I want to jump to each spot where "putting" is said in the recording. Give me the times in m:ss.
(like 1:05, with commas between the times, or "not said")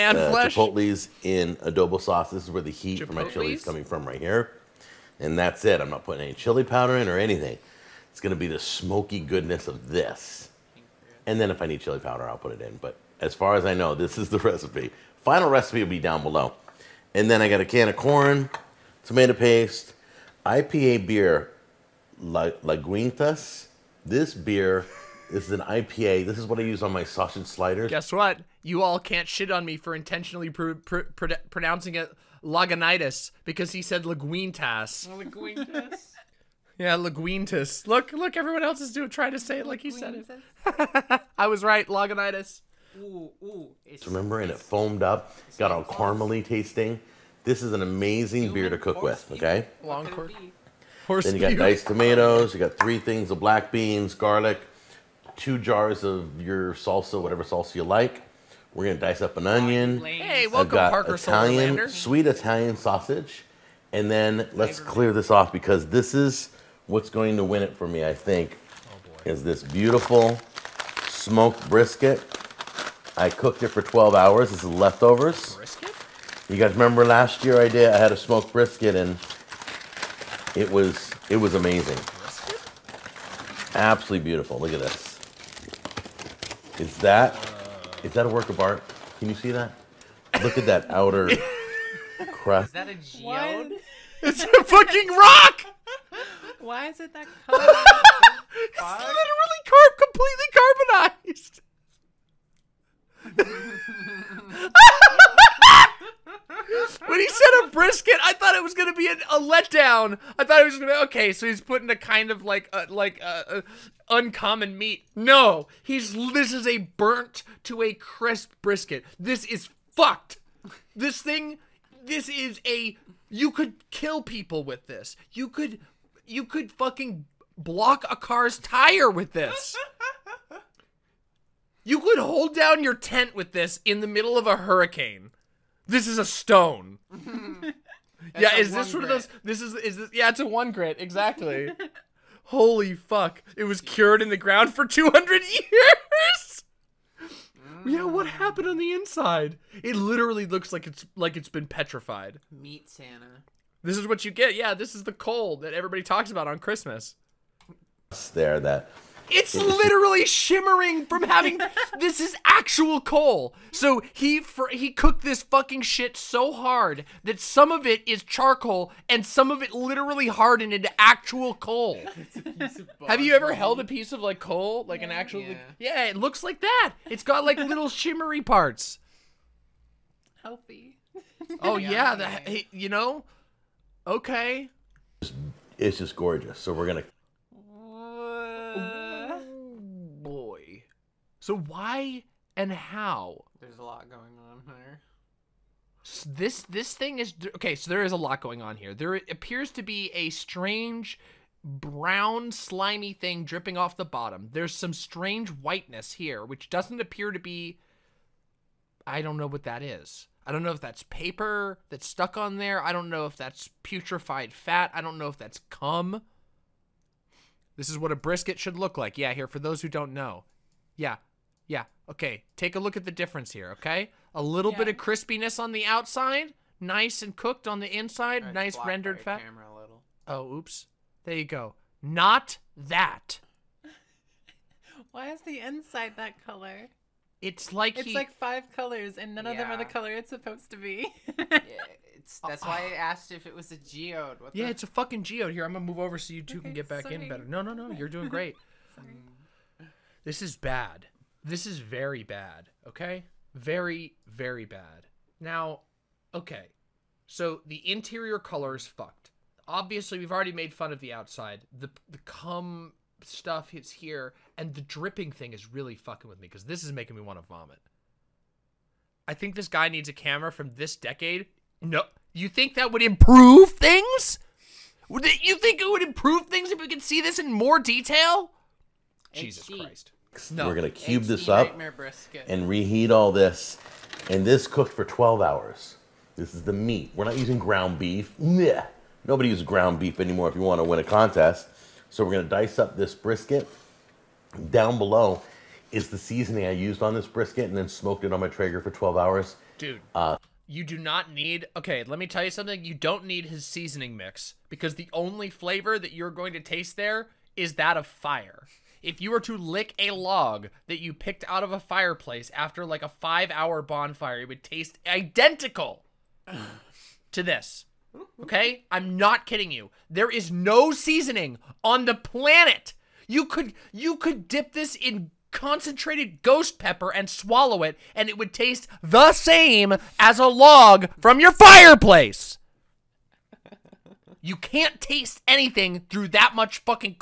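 0:06, 1:51.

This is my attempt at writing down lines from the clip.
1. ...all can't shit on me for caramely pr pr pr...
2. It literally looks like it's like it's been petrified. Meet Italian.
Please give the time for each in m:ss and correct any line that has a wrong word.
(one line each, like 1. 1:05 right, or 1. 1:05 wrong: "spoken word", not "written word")
1. 0:28 wrong: "intentionally", not "caramely"
2. 2:29 wrong: "Santa", not "Italian".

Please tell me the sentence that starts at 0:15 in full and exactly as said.
Final recipe will be down below.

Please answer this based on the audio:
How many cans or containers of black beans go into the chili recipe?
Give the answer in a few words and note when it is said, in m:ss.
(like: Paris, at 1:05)
3, at 0:52.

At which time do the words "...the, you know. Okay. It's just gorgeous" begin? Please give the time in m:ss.
3:02.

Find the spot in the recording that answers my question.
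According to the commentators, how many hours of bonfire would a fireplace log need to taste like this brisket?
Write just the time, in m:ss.
5:13.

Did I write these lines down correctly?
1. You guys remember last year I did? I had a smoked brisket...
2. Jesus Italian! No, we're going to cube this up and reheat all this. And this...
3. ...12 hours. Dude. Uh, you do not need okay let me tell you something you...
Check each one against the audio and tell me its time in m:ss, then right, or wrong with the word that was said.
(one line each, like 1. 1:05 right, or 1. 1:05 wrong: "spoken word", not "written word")
1. 1:16 right
2. 4:39 wrong: "Christ", not "Italian"
3. 4:58 right.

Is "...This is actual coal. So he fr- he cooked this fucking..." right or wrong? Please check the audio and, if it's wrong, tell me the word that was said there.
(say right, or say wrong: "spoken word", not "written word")
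right.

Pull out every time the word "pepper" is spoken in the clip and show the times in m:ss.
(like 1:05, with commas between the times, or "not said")
5:26.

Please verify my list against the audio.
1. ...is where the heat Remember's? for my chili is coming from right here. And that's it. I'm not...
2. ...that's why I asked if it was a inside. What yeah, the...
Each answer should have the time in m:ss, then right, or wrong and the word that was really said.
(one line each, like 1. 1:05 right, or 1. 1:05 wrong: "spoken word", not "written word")
1. 0:02 wrong: "Chipotle", not "Remember"
2. 4:02 wrong: "geode", not "inside".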